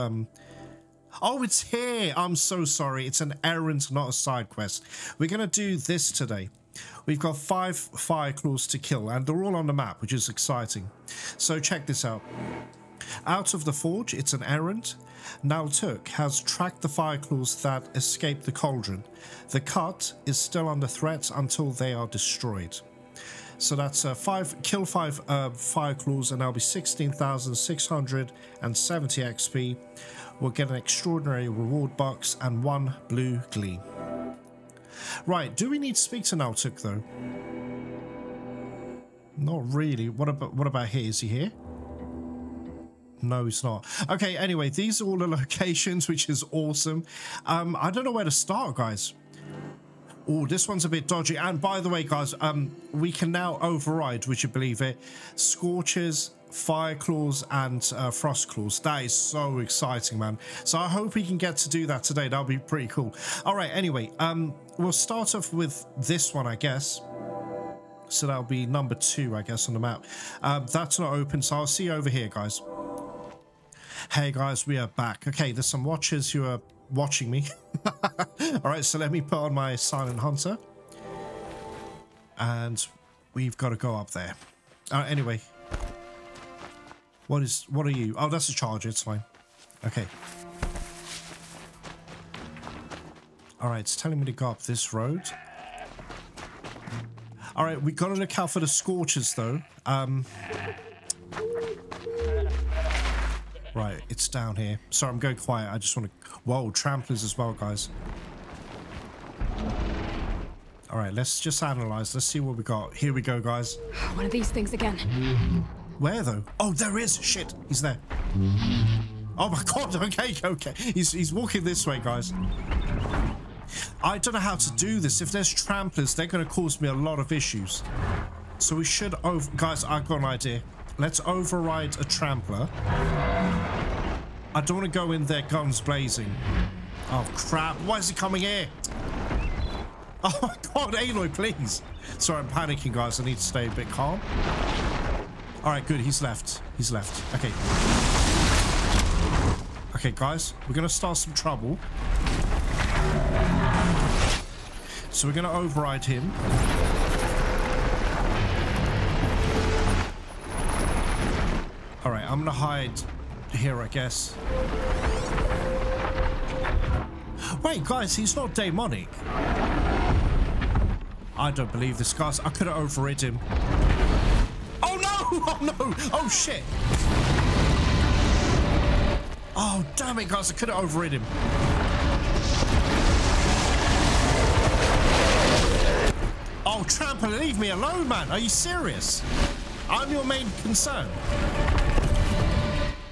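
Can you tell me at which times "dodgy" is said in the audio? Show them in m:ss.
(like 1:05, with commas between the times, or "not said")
0:51.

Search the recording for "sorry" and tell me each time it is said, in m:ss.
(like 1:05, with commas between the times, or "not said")
0:02, 1:44, 2:22.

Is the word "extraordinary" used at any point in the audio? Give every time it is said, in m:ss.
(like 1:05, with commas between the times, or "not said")
0:30.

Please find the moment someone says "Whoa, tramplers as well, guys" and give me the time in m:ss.
1:46.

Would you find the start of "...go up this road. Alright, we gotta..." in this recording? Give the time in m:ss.
1:34.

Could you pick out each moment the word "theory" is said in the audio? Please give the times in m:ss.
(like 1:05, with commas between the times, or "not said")
not said.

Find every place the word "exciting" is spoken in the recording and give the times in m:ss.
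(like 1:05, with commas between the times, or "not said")
0:10, 0:59.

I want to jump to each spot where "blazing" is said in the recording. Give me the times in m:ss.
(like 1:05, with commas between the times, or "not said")
2:15.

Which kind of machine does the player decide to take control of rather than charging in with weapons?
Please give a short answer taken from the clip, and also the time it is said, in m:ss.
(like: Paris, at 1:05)
trampler, at 2:12.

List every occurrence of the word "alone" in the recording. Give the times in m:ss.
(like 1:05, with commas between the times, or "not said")
3:07.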